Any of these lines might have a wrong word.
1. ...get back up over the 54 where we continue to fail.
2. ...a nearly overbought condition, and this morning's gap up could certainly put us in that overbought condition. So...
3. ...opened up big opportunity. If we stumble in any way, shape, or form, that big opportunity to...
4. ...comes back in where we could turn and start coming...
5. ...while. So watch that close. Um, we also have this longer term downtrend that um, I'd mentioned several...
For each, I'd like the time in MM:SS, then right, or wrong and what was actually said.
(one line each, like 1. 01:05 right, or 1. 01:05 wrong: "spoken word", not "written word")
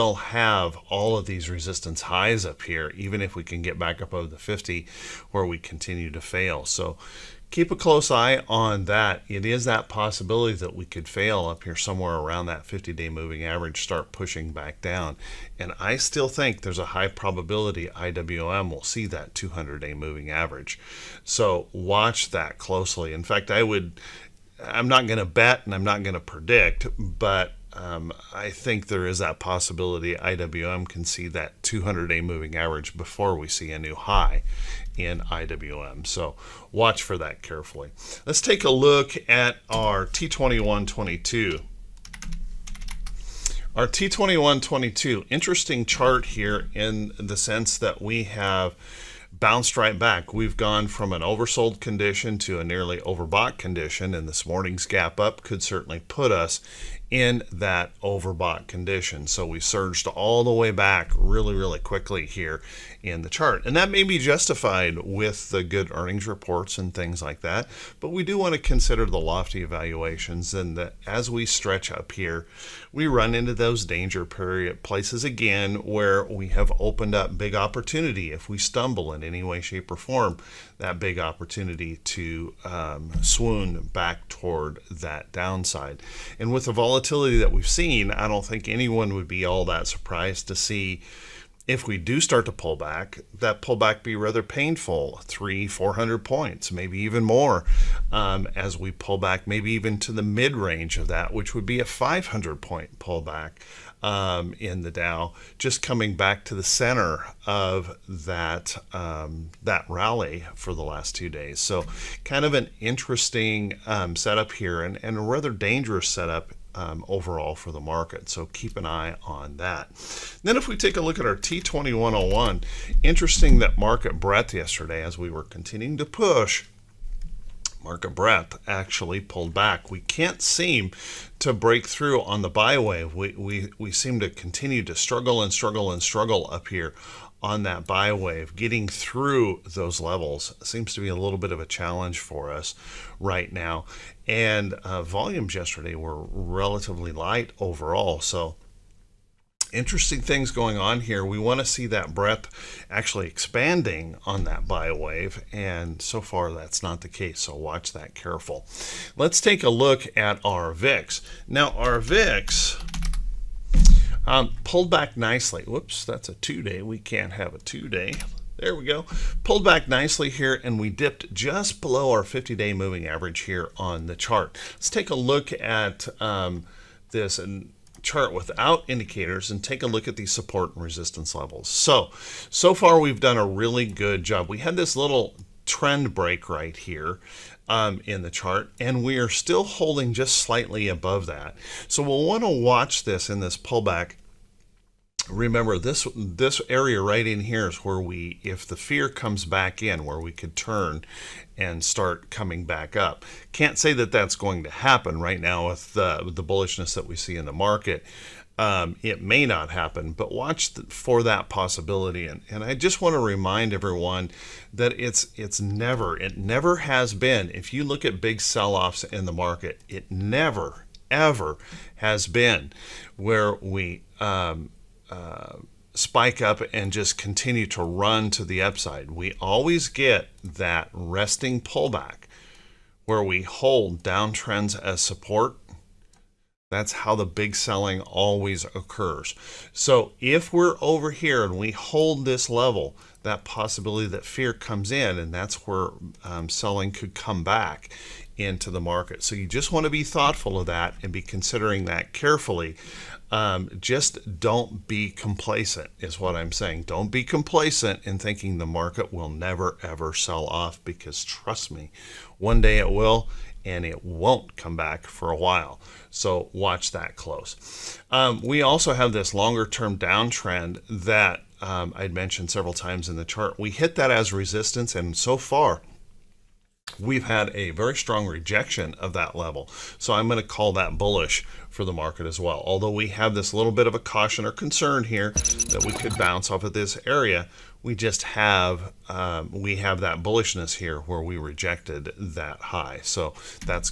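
1. 00:03 wrong: "50", not "54"
2. 00:52 right
3. 01:16 right
4. 03:19 right
5. 04:25 right.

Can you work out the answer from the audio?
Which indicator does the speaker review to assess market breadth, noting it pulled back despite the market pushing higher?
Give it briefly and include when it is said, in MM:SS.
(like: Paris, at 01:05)
T2101, at 02:01.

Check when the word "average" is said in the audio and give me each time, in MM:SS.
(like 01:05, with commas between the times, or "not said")
00:13, 00:20, 00:32, 02:53.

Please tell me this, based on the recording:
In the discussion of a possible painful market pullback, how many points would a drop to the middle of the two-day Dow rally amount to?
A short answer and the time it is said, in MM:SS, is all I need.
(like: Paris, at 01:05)
500 points, at 01:41.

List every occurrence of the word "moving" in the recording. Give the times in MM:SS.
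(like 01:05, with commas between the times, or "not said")
00:13, 00:19, 00:32, 02:52.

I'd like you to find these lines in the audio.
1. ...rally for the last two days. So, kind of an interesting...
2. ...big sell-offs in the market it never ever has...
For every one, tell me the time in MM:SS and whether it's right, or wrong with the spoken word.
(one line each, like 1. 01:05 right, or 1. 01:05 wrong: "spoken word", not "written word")
1. 01:49 right
2. 03:38 right.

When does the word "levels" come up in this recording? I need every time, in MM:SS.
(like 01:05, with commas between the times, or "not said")
02:19, 03:01, 04:02, 04:39.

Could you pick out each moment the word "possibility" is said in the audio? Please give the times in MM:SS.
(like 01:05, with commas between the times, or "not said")
00:09, 00:29, 03:31, 04:03.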